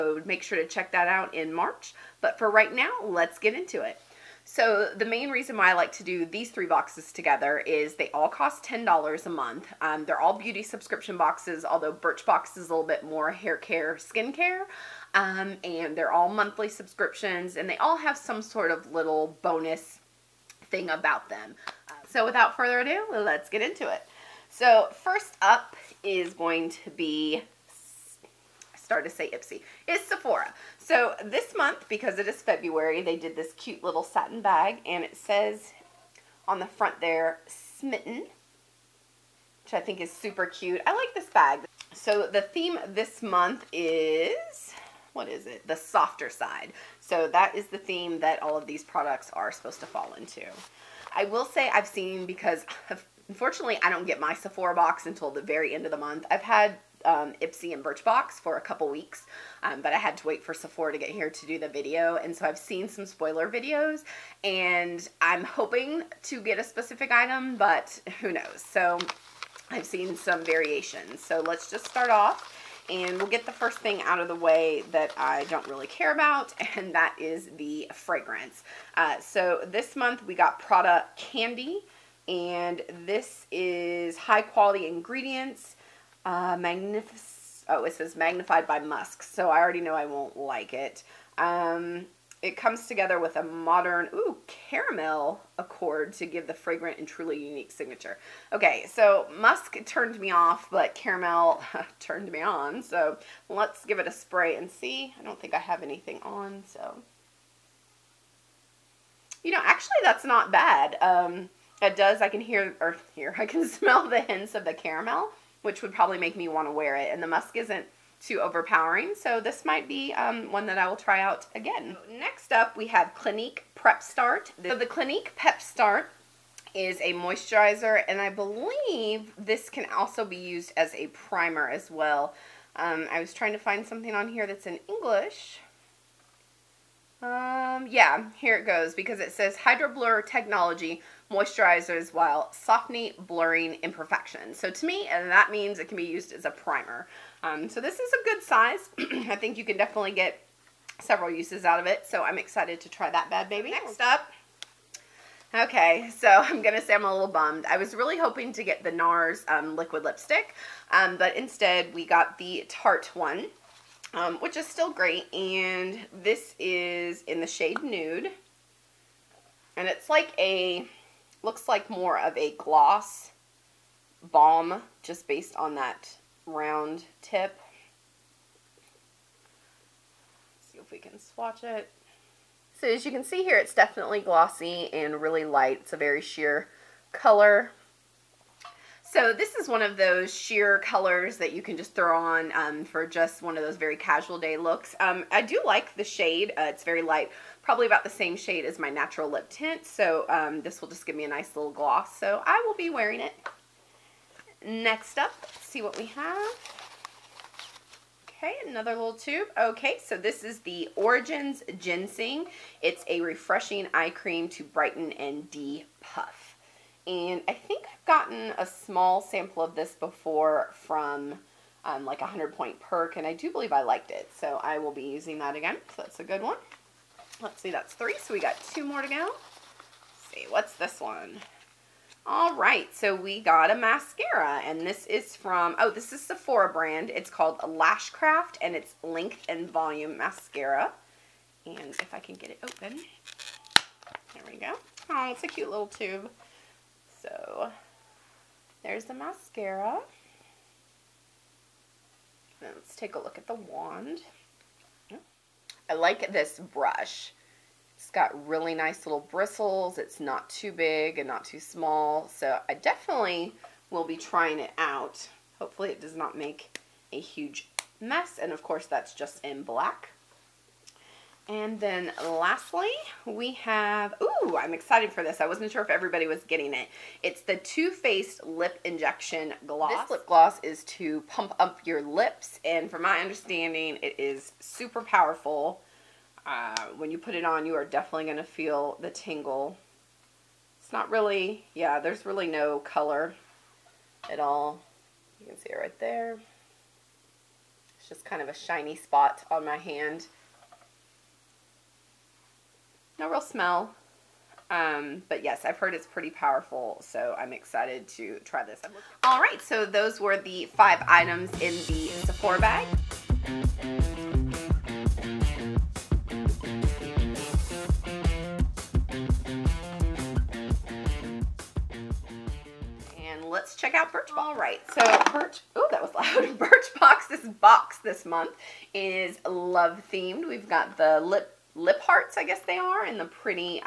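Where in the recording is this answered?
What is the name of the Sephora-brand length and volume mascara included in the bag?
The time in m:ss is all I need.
3:57.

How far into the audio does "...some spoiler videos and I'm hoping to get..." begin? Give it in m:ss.
1:02.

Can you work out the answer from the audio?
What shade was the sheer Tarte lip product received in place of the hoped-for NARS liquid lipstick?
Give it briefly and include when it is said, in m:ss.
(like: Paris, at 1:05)
Nude, at 2:47.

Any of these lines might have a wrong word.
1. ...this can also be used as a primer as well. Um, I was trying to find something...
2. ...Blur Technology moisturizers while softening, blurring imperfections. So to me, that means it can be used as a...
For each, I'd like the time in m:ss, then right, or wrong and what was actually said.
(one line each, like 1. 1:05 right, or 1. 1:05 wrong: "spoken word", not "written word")
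1. 2:09 right
2. 2:19 right.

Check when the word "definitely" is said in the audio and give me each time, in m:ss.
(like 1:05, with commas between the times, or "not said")
2:29, 3:03, 4:22, 4:47.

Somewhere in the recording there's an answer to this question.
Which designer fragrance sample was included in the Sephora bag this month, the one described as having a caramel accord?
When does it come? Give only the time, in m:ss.
1:20.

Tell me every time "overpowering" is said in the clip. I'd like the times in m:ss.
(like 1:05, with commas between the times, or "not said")
1:58.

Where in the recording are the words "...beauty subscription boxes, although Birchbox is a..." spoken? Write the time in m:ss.
0:10.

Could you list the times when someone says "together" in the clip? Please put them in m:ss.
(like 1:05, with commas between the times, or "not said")
0:07, 1:32.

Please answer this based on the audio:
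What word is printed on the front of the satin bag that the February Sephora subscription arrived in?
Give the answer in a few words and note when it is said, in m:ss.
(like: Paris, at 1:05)
Smitten, at 0:37.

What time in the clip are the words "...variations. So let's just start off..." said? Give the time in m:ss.
1:10.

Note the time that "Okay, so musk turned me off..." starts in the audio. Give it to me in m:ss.
1:38.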